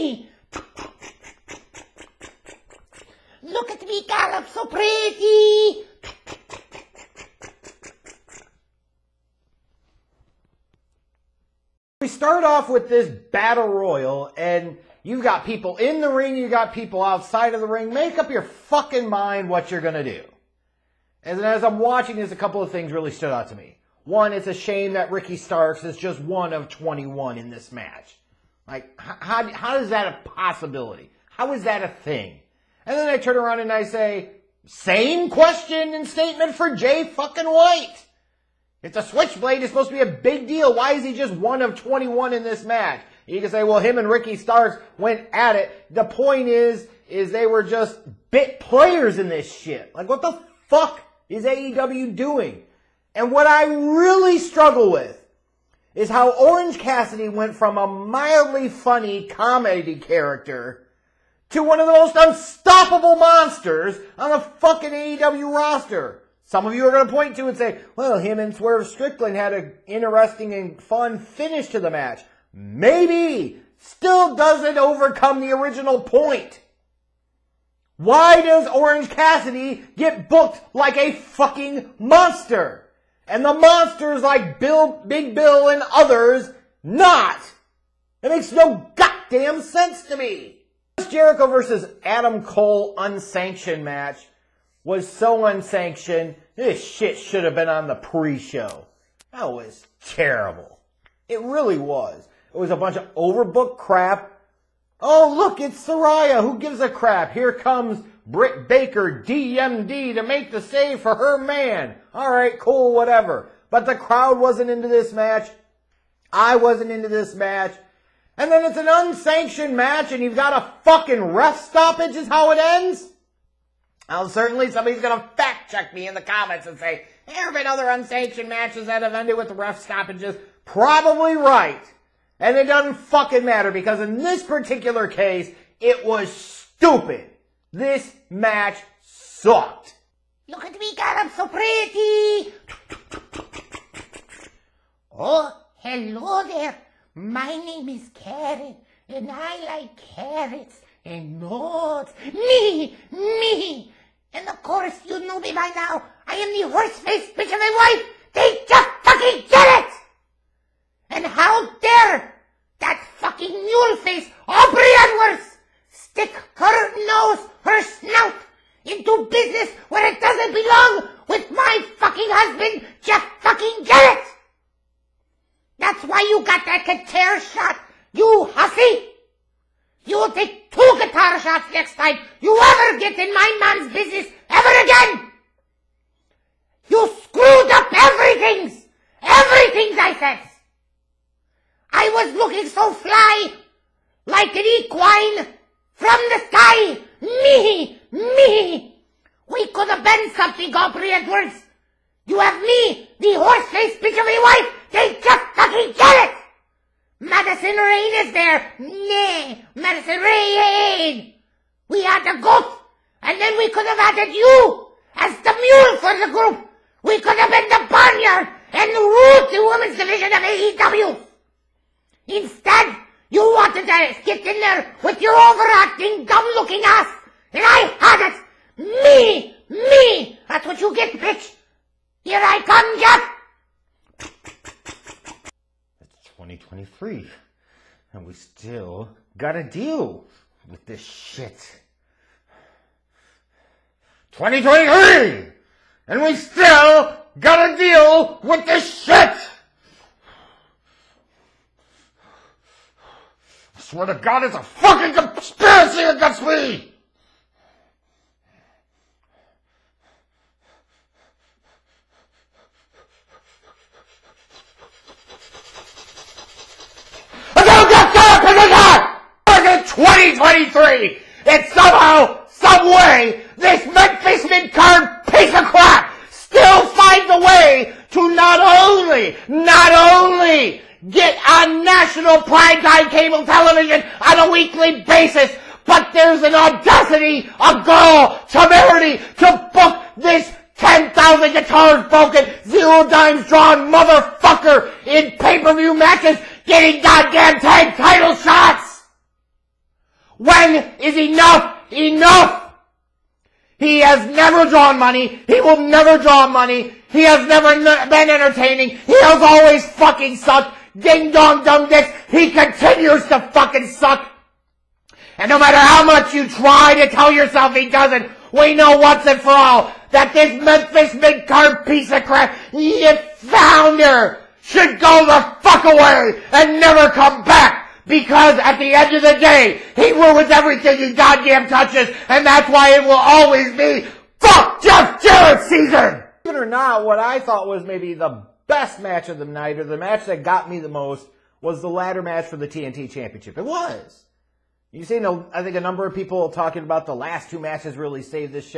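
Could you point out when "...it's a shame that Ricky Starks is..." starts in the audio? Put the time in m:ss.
0:24.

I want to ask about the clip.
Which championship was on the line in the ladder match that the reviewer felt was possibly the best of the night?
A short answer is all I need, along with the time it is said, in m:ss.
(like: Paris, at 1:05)
TNT Championship, at 5:42.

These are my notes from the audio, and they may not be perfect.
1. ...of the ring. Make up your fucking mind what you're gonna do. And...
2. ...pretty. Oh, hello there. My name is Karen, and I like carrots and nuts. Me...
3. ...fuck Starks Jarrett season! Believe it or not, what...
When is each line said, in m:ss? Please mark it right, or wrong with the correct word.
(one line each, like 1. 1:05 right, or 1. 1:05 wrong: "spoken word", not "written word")
1. 0:17 right
2. 2:21 right
3. 5:34 wrong: "Jeff", not "Starks".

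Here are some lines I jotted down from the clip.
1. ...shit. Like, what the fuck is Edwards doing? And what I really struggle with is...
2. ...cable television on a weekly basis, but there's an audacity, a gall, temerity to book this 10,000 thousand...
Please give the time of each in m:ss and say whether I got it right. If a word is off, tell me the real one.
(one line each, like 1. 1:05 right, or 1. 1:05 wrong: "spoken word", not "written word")
1. 0:49 wrong: "AEW", not "Edwards"
2. 4:43 right.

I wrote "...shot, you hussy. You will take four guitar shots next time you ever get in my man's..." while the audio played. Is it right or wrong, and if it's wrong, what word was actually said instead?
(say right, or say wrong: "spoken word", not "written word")
wrong: "two", not "four".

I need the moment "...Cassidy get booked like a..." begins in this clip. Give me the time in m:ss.
1:19.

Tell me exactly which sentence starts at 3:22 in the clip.
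You have me, the horse bitch of a wife.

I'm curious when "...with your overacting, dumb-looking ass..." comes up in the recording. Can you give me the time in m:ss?
3:45.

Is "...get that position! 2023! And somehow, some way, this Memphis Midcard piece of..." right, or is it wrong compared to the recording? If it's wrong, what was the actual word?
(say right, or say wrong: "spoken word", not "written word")
right.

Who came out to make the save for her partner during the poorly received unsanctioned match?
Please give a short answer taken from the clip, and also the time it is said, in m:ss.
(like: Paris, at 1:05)
Britt Baker, at 1:48.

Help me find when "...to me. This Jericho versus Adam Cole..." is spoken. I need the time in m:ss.
1:30.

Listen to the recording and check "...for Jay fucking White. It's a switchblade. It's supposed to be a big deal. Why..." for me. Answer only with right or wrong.
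right.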